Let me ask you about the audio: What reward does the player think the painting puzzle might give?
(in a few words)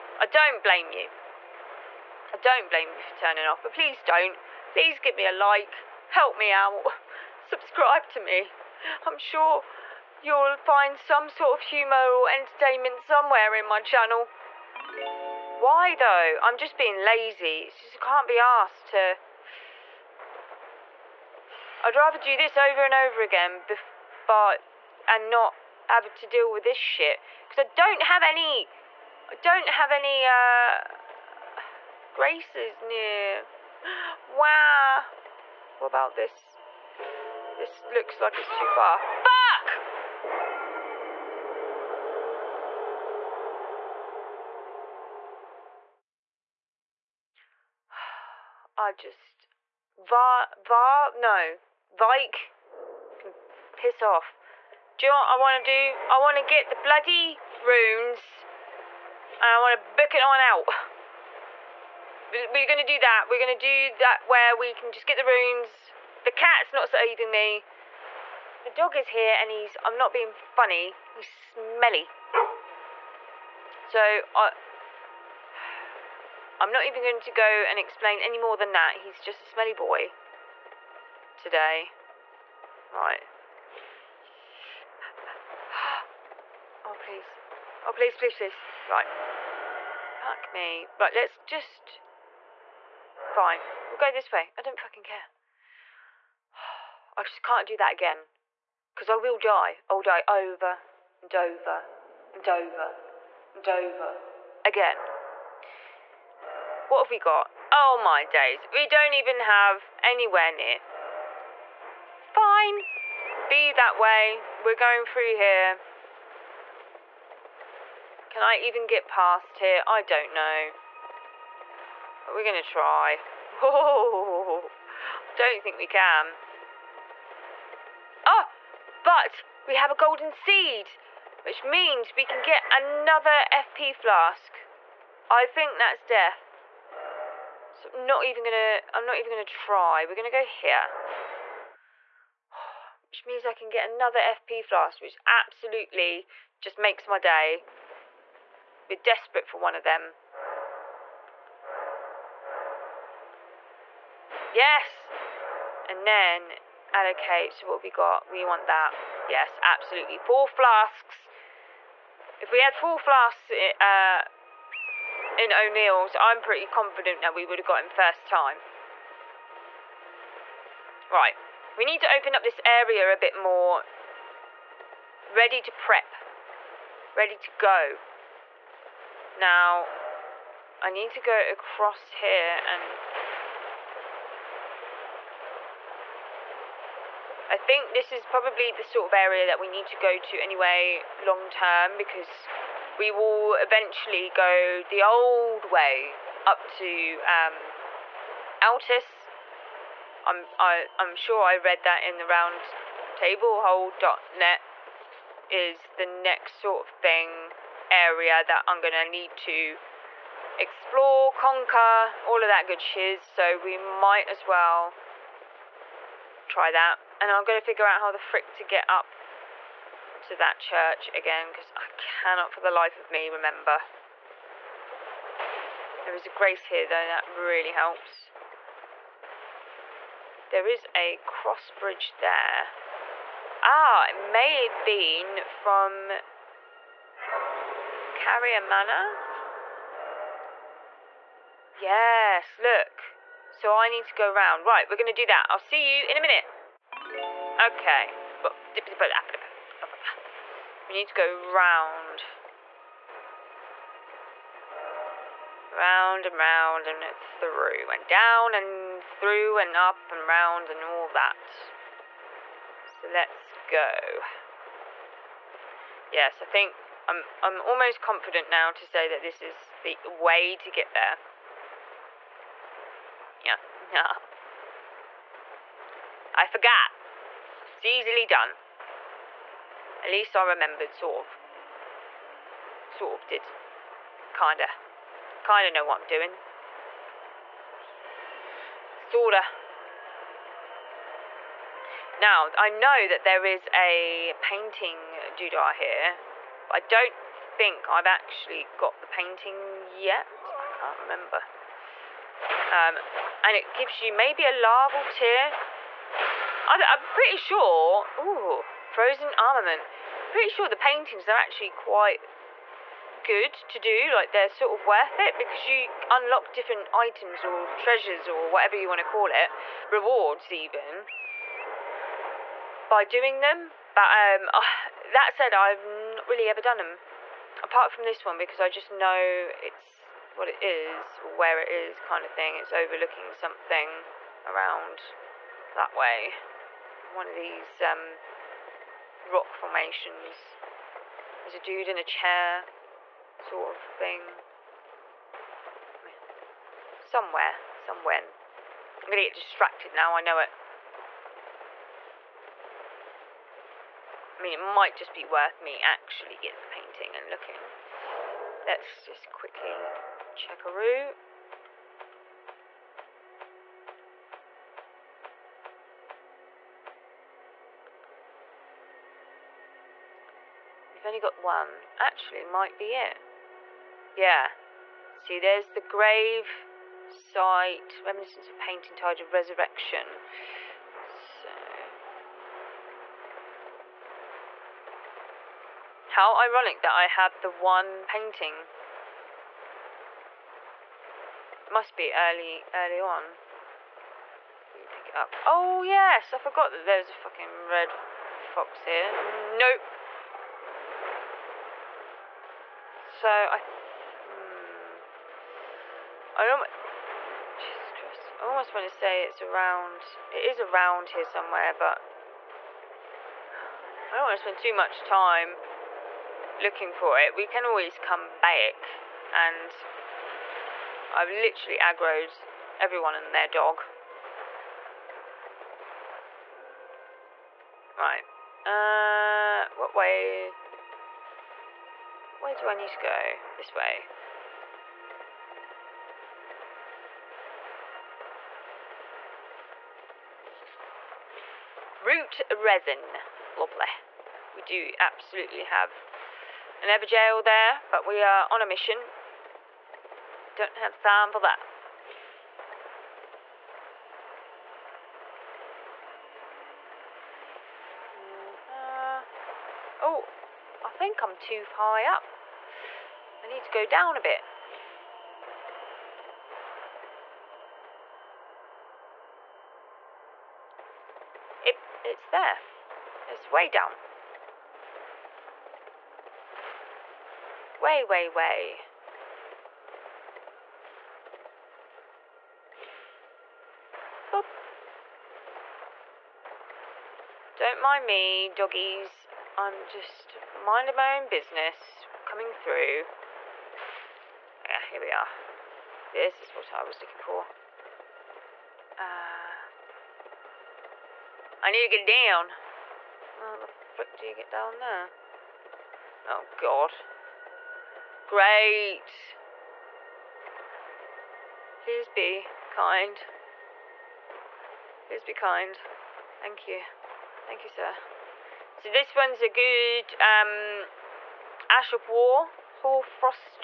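larval tear.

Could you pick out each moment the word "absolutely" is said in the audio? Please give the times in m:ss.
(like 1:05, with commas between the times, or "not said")
2:25, 2:39, 7:24.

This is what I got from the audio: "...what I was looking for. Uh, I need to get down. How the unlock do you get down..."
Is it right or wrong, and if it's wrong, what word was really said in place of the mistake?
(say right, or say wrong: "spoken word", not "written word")
wrong: "frick", not "unlock".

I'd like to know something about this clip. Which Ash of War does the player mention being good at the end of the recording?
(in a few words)
Hoarfrost.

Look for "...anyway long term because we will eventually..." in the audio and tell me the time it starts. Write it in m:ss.
3:10.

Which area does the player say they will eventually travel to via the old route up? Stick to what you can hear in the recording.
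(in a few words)
Altus.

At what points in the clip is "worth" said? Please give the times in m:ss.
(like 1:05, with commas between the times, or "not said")
5:14, 5:55.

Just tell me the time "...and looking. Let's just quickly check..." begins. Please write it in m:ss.
5:57.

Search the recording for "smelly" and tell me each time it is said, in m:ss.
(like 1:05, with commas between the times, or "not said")
1:11, 1:19.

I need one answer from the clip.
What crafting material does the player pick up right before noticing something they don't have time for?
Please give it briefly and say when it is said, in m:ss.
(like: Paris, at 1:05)
Root resin, at 7:22.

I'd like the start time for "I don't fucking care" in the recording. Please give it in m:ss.
1:34.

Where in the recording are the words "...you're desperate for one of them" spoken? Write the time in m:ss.
2:28.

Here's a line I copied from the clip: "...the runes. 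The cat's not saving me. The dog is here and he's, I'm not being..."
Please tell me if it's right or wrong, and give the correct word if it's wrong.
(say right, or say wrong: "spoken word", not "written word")
right.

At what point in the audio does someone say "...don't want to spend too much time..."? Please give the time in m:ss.
6:54.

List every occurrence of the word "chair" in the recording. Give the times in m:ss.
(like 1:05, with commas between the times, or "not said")
5:42.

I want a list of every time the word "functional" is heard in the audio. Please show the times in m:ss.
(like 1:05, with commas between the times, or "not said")
not said.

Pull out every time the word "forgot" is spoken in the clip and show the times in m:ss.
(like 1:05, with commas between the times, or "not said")
4:36, 6:36.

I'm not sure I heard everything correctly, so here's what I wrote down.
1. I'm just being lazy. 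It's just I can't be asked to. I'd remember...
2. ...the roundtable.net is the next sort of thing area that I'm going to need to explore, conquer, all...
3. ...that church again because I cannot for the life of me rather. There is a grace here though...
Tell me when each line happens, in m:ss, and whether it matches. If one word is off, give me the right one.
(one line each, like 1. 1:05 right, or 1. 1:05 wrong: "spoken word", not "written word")
1. 0:16 wrong: "rather", not "remember"
2. 3:22 right
3. 3:40 wrong: "remember", not "rather".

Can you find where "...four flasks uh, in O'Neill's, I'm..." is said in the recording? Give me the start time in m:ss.
2:42.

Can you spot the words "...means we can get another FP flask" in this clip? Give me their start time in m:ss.
2:11.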